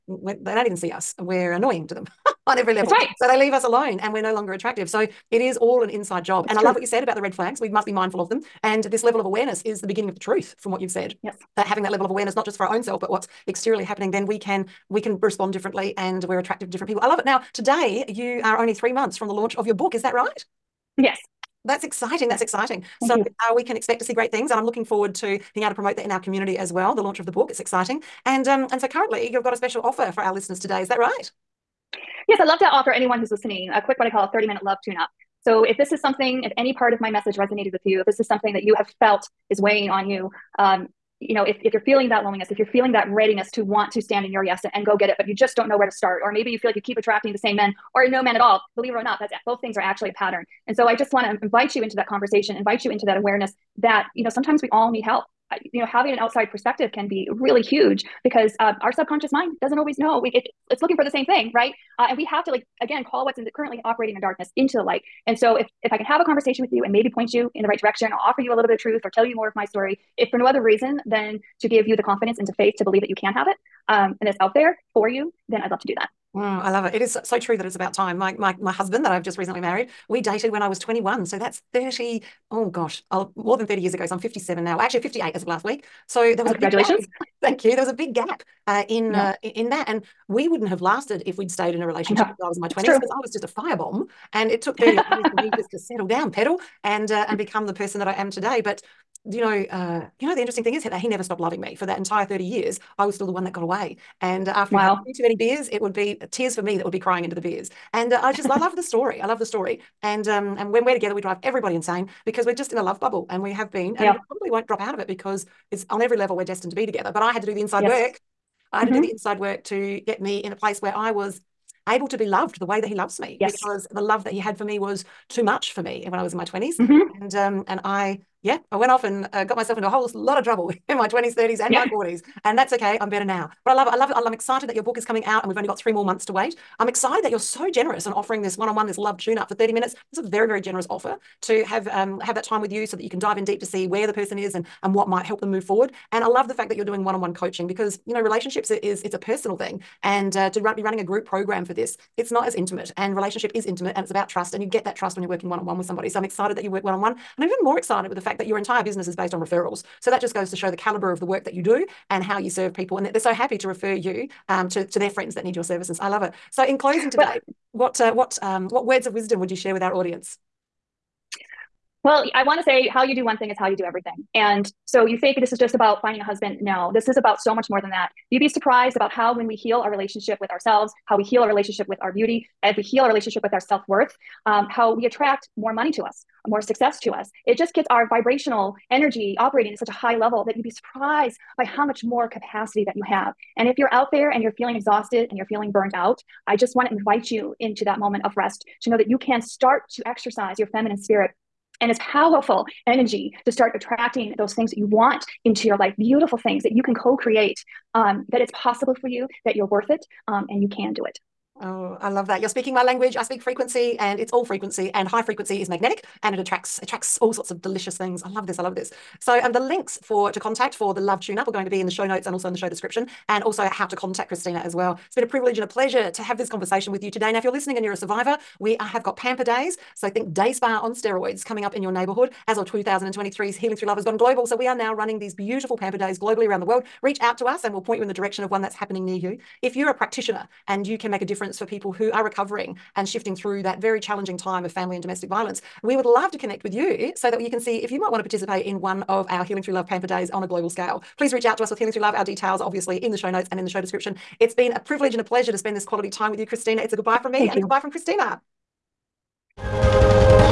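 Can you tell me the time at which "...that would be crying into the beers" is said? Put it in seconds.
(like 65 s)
106 s.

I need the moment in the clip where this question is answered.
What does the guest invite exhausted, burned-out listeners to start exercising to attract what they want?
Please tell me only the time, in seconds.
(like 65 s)
200 s.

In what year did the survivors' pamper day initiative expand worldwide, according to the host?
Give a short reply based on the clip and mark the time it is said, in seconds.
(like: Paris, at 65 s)
2023, at 232 s.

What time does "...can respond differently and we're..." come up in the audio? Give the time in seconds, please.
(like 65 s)
15 s.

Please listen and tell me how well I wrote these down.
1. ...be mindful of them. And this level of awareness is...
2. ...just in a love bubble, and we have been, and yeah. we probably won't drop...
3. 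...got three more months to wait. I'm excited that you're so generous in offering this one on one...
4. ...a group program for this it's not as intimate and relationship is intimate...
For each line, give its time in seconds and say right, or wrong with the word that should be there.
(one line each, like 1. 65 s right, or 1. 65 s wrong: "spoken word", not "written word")
1. 7 s right
2. 112 s right
3. 135 s right
4. 150 s right.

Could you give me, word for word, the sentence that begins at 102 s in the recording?
I was still the one that got away.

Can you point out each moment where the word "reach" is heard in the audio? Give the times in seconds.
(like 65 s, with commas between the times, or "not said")
237 s, 251 s.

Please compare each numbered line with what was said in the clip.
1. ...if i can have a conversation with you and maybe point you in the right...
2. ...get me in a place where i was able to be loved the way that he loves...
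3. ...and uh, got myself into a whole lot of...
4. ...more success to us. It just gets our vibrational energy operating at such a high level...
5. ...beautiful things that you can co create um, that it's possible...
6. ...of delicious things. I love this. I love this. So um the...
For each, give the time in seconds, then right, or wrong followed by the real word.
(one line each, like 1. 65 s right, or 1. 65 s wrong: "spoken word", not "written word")
1. 65 s right
2. 120 s right
3. 129 s right
4. 186 s right
5. 205 s right
6. 217 s right.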